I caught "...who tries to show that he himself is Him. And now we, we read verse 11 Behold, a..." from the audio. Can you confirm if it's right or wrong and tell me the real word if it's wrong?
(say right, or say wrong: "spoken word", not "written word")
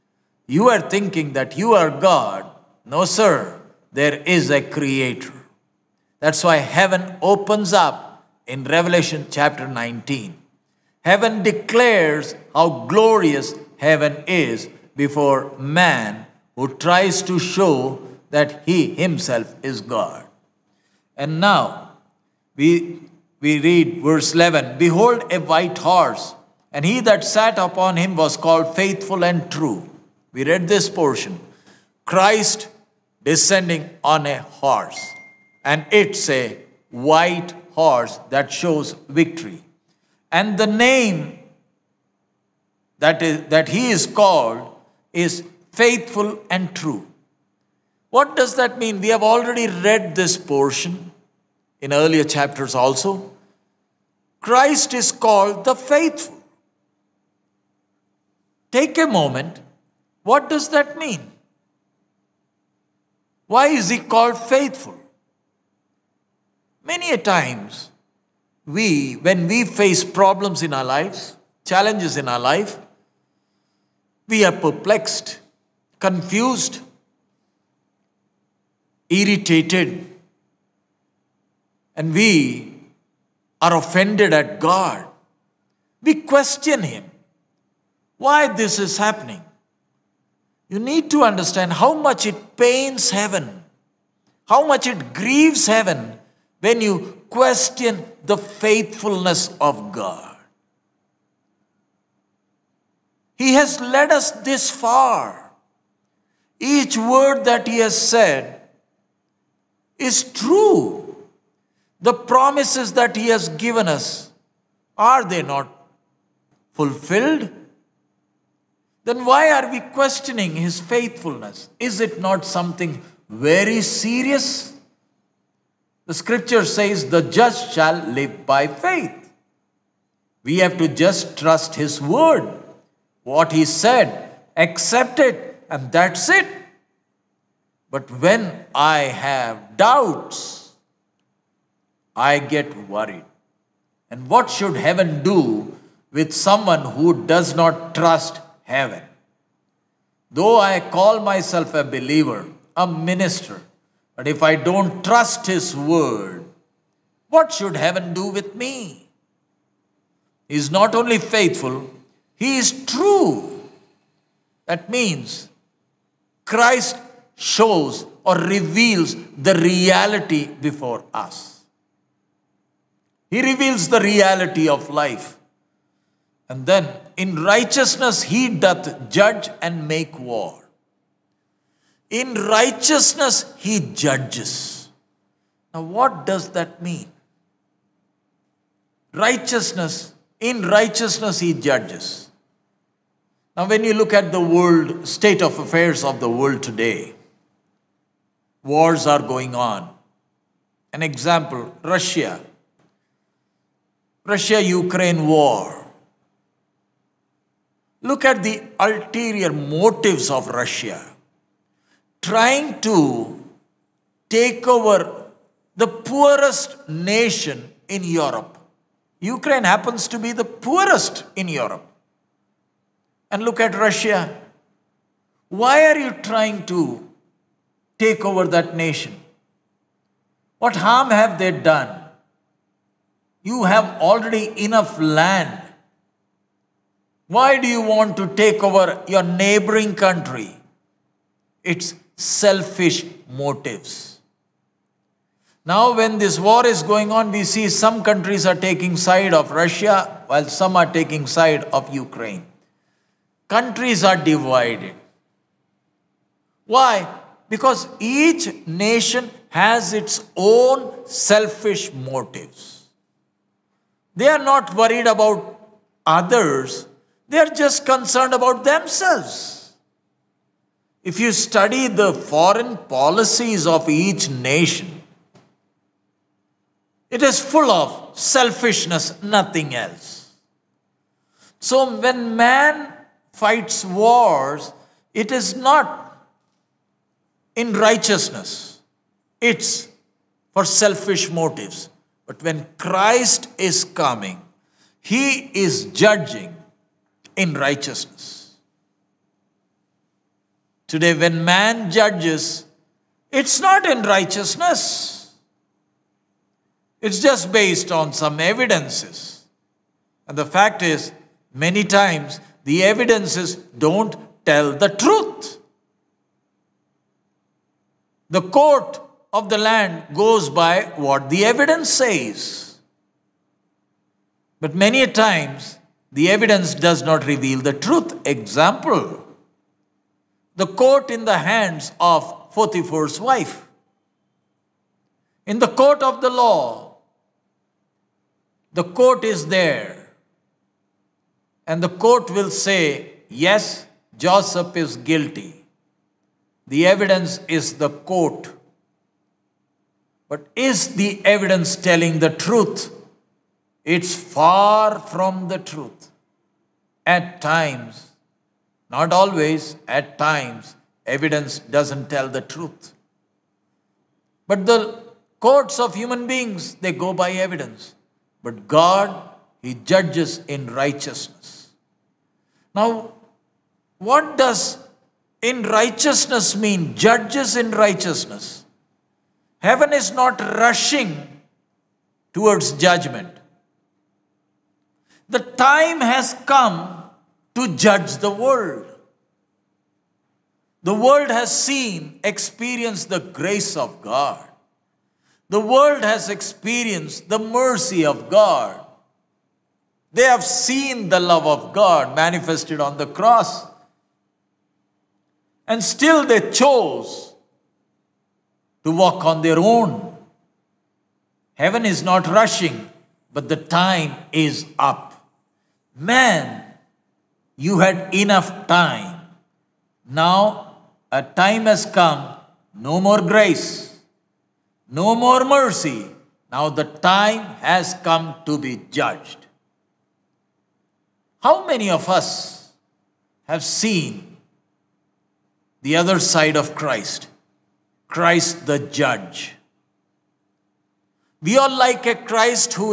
wrong: "God", not "Him".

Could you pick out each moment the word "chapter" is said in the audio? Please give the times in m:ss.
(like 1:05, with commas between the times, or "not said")
0:09, 0:52.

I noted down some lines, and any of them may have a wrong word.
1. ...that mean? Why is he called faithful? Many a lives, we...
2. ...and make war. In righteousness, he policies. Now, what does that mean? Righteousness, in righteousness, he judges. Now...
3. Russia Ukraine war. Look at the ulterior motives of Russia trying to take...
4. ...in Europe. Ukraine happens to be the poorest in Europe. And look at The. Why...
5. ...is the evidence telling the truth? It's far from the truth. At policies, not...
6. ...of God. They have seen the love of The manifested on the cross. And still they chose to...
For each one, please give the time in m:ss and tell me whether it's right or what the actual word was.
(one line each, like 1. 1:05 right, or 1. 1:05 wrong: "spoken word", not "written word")
1. 1:00 wrong: "times", not "lives"
2. 2:59 wrong: "judges", not "policies"
3. 3:24 right
4. 3:37 wrong: "Russia", not "The"
5. 5:50 wrong: "times", not "policies"
6. 6:38 wrong: "God", not "The".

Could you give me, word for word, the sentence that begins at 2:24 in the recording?
And what should heaven do with someone who does not trust heaven?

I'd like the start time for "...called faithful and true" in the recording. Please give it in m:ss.
0:28.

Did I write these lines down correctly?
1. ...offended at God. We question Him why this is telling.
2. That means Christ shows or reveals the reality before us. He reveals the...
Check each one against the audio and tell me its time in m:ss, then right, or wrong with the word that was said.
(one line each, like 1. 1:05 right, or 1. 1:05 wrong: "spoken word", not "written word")
1. 1:23 wrong: "happening", not "telling"
2. 2:44 right.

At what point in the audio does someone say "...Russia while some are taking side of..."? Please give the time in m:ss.
4:09.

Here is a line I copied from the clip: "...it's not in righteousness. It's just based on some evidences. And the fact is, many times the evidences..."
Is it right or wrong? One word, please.
right.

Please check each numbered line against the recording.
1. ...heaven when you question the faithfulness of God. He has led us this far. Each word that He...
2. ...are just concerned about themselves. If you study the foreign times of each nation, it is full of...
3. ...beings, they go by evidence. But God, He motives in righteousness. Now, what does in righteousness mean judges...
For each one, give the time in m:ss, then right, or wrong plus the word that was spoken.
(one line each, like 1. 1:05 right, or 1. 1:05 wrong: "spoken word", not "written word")
1. 1:35 right
2. 4:27 wrong: "policies", not "times"
3. 6:06 wrong: "judges", not "motives".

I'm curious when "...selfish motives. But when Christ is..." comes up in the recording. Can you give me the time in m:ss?
4:50.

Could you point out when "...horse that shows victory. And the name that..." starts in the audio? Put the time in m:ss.
0:37.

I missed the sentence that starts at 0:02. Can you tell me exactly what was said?
No, sir, there is a creator.